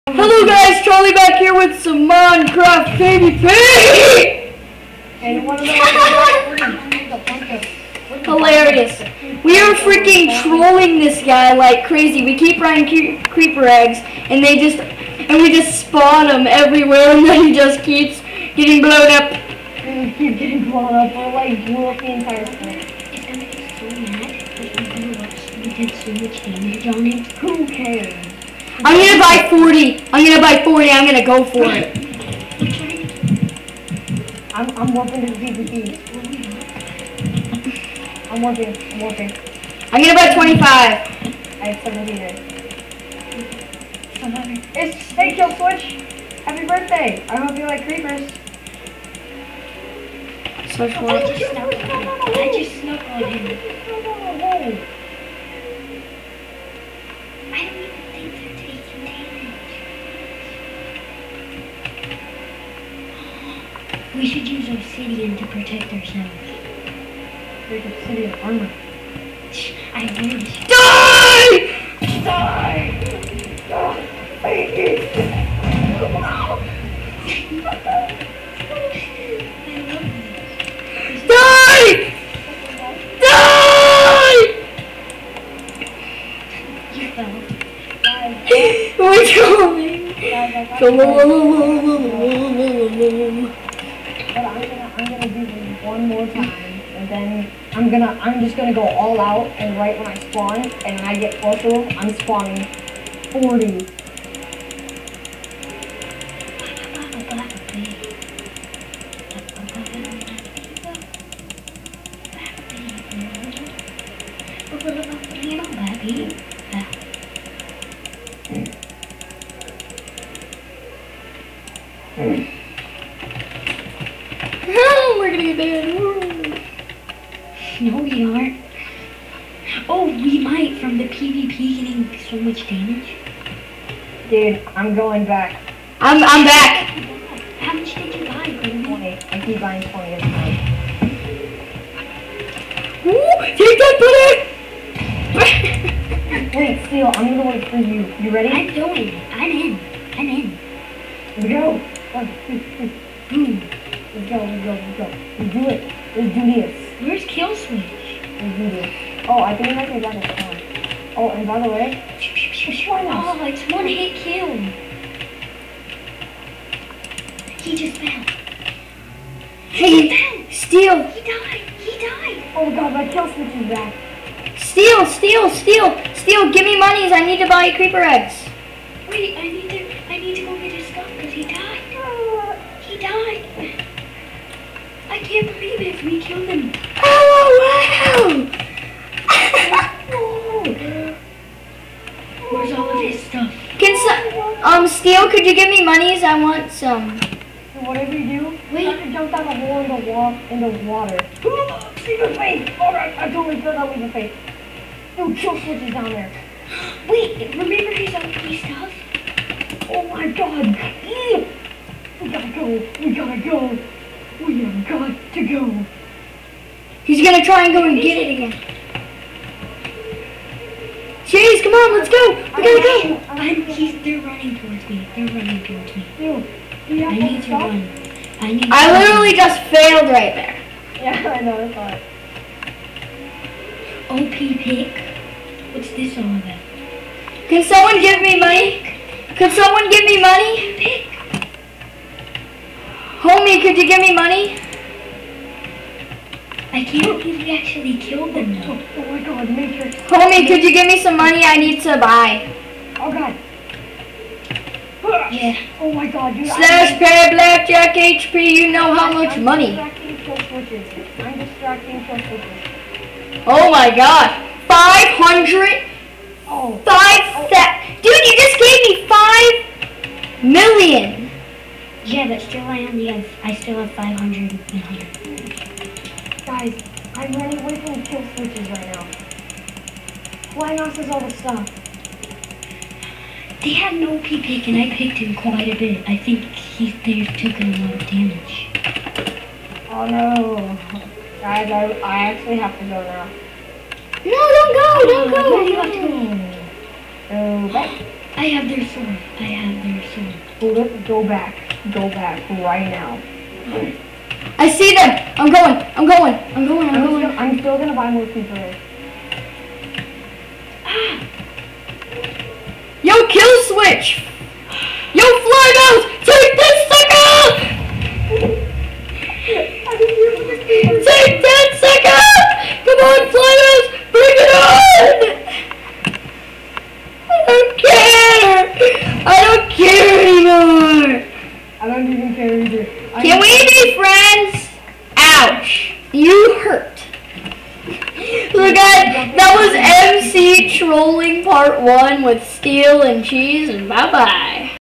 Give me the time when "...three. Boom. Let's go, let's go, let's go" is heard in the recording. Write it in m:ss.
2:32.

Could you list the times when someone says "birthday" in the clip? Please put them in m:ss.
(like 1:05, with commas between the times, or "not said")
0:46.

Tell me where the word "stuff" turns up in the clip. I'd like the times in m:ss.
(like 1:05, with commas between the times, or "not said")
3:13, 3:28, 4:41.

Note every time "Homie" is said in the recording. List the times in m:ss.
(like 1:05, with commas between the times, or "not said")
4:03, 4:10.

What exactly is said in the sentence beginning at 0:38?
I'm working, I'm I'm gonna buy 25.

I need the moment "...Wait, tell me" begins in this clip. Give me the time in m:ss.
1:28.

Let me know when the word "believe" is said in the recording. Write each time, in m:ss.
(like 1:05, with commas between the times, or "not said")
4:07.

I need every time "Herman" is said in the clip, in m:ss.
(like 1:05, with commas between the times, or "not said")
not said.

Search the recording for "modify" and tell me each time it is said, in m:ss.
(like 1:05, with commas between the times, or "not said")
not said.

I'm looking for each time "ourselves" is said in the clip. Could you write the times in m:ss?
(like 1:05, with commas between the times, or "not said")
1:05.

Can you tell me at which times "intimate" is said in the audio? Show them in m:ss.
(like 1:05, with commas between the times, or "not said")
not said.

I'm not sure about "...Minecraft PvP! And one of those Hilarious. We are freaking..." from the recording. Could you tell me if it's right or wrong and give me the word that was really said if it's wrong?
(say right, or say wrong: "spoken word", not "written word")
right.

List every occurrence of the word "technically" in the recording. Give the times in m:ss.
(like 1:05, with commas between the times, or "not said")
not said.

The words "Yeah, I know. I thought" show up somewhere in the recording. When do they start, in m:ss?
3:50.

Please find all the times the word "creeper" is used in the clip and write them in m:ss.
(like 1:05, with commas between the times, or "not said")
0:13, 0:47, 2:57.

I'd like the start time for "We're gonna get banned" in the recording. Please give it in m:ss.
2:05.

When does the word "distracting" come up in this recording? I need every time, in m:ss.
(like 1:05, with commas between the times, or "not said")
4:21.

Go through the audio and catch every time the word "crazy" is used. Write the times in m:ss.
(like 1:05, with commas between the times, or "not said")
0:11.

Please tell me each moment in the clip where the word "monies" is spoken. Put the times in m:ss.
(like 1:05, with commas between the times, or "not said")
2:56, 3:15.